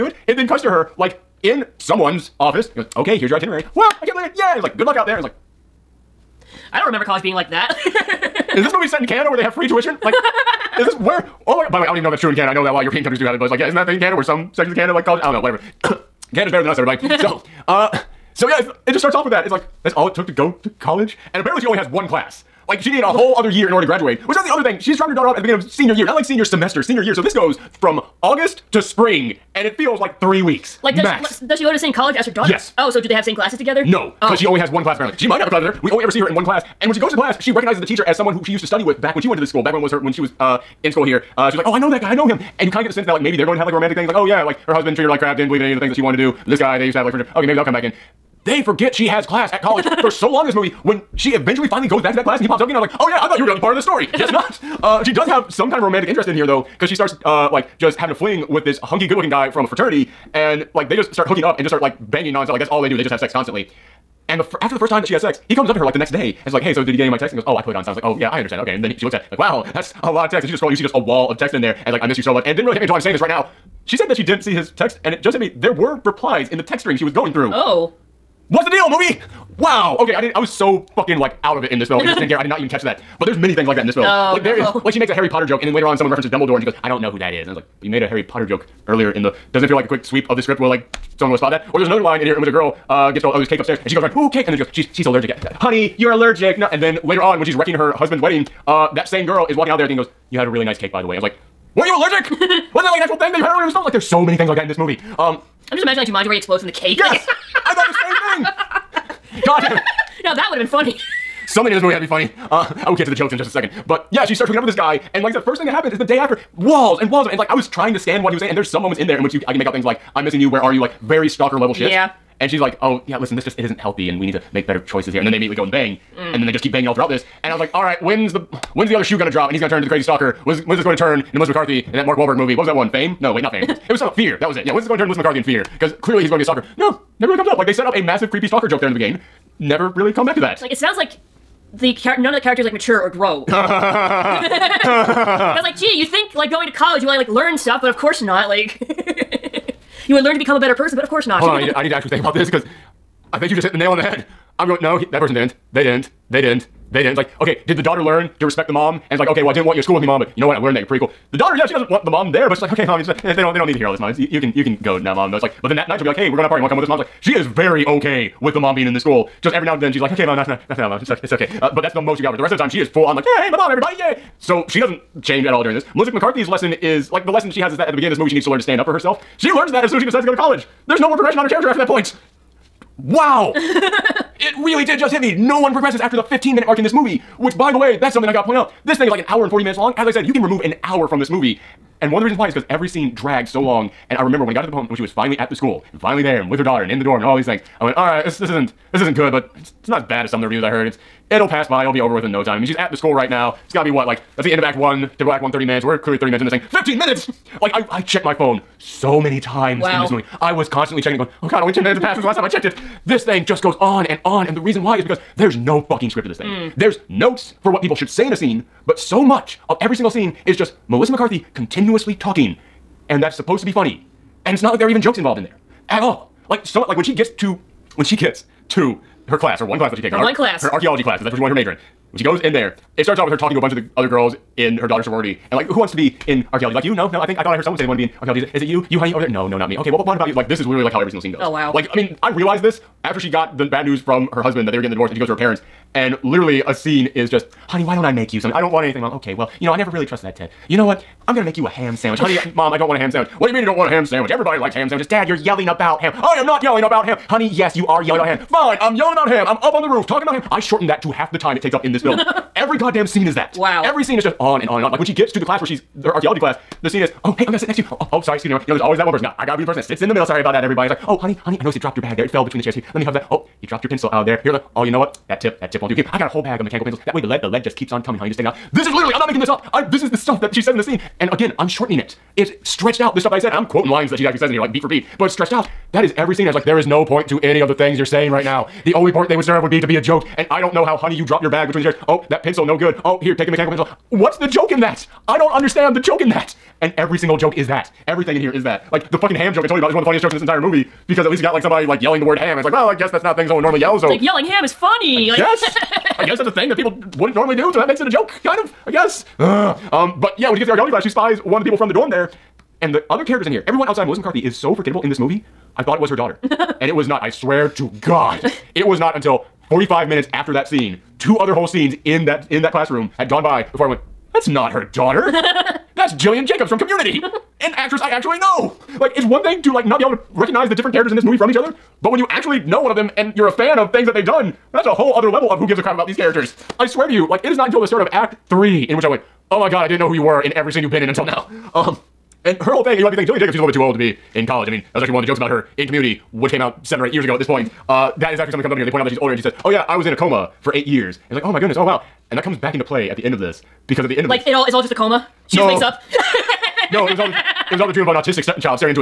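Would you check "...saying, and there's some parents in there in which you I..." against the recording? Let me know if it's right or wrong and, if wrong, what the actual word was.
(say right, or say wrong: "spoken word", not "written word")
wrong: "moments", not "parents".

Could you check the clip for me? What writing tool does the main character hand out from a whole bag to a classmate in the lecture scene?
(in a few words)
Mechanical pencils.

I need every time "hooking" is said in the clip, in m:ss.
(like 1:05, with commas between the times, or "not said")
1:01, 1:54.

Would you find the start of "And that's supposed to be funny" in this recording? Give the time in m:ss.
3:43.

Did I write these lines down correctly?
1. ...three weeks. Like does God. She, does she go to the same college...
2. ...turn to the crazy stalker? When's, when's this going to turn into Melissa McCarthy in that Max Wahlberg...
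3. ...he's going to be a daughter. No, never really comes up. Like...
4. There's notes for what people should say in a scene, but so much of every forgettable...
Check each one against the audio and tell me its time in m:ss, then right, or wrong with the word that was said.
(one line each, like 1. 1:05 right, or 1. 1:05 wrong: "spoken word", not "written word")
1. 0:30 wrong: "Max", not "God"
2. 2:09 wrong: "Mark", not "Max"
3. 2:16 wrong: "stalker", not "daughter"
4. 3:36 wrong: "single", not "forgettable".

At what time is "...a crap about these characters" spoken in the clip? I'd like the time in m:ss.
5:35.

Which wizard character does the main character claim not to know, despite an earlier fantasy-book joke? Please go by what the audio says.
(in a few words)
Dumbledore.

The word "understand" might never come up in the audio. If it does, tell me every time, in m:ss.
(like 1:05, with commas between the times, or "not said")
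1:08, 4:55.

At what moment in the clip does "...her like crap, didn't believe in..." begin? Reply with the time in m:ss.
0:45.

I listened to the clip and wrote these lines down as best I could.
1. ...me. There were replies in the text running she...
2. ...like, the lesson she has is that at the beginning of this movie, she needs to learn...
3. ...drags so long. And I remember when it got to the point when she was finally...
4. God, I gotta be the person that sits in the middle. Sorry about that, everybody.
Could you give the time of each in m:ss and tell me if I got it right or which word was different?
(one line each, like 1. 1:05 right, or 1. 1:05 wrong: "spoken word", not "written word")
1. 1:15 wrong: "string", not "running"
2. 2:57 right
3. 3:13 right
4. 4:29 right.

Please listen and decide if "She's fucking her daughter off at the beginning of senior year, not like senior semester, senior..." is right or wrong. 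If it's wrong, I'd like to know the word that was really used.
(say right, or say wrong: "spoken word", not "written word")
wrong: "dropping", not "fucking".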